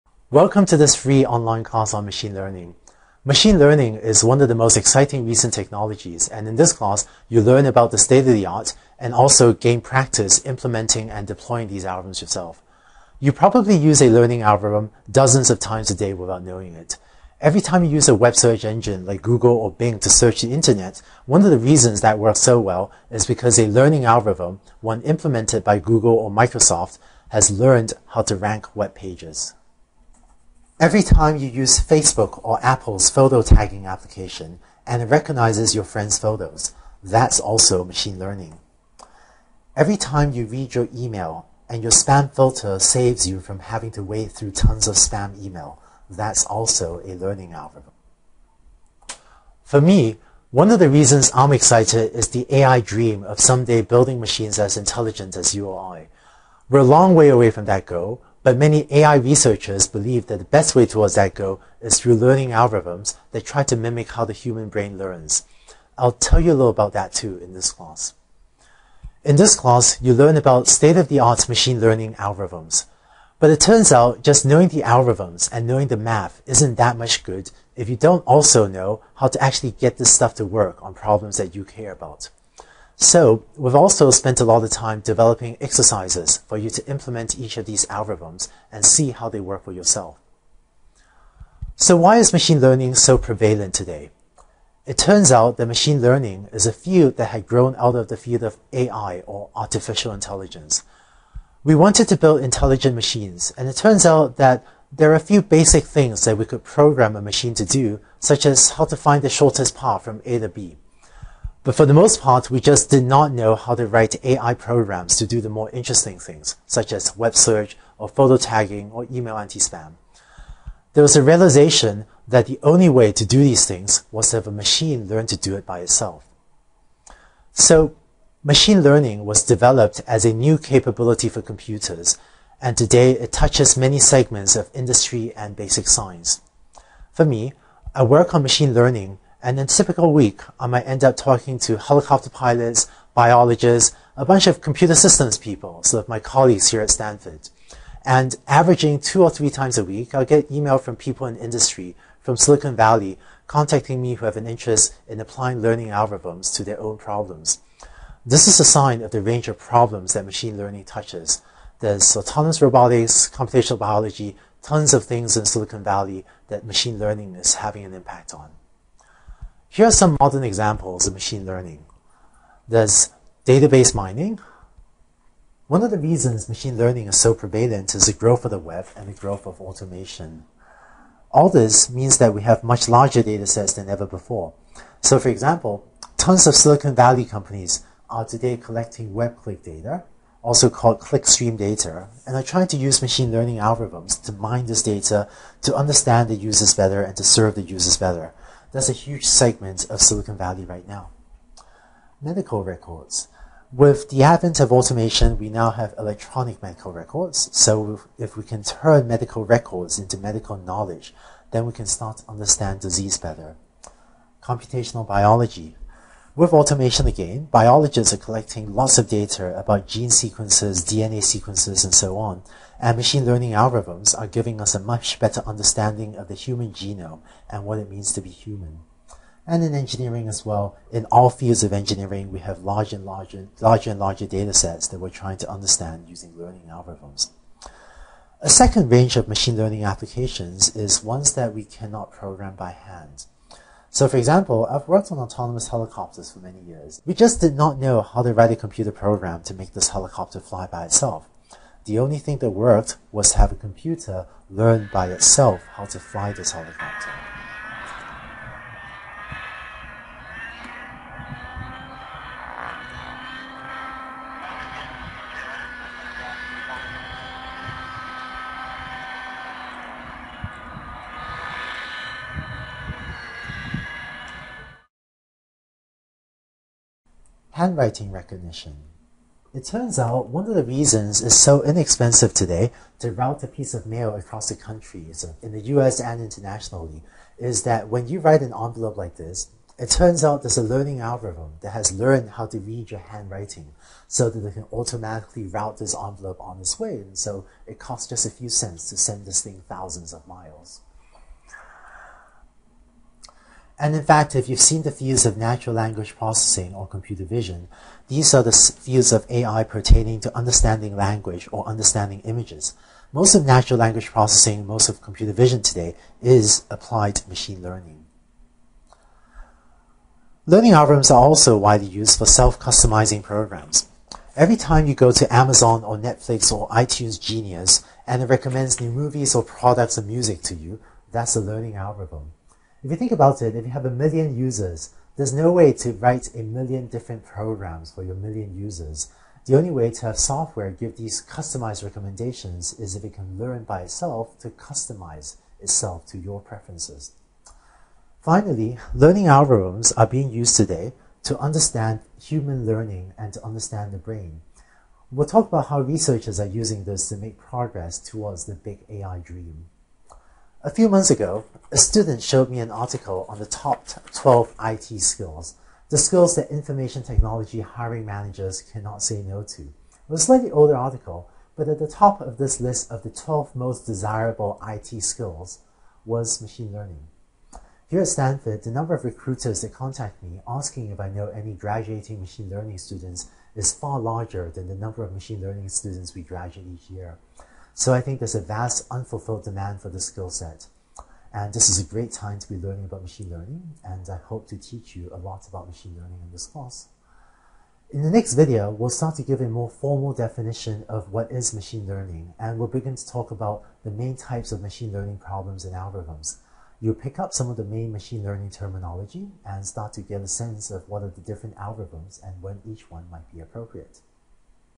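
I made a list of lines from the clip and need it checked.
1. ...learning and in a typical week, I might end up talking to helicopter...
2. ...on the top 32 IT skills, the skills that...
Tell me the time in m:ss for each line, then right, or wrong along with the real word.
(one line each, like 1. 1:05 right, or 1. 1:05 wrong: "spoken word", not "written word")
1. 2:18 right
2. 6:03 wrong: "12", not "32".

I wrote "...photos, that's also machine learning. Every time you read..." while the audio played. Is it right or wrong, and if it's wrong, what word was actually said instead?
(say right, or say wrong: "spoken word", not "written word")
right.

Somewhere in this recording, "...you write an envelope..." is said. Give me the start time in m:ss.
4:48.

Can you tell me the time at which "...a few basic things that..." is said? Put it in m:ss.
1:45.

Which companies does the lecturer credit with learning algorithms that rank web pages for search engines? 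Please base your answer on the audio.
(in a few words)
Google or Microsoft.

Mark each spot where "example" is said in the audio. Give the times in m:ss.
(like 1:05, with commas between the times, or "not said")
2:50, 3:05, 4:04.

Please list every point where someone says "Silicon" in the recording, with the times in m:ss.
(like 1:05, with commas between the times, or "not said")
2:32, 2:45, 3:06, 3:20.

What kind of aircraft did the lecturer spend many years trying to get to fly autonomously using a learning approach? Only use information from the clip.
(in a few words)
helicopters.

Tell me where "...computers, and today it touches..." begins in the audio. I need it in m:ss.
2:11.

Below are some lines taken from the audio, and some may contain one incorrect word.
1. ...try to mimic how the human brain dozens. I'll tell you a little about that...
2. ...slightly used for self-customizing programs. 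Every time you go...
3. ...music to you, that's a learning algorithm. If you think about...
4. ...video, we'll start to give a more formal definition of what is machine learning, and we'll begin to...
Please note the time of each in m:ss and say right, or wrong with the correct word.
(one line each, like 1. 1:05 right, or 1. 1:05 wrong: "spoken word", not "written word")
1. 1:03 wrong: "learns", not "dozens"
2. 5:21 wrong: "widely", not "slightly"
3. 5:30 right
4. 6:38 right.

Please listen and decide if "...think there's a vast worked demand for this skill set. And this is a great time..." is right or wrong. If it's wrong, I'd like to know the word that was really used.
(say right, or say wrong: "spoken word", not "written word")
wrong: "unfulfilled", not "worked".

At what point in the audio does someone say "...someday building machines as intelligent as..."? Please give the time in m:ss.
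0:53.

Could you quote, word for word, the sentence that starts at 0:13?
You probably use a learning algorithm dozens of times a day without knowing it.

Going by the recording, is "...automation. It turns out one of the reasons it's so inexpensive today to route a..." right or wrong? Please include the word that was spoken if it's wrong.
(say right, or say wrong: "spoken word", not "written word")
wrong: "recognition", not "automation".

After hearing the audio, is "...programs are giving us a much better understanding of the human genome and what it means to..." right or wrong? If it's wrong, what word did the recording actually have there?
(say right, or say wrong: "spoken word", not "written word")
wrong: "algorithms", not "programs".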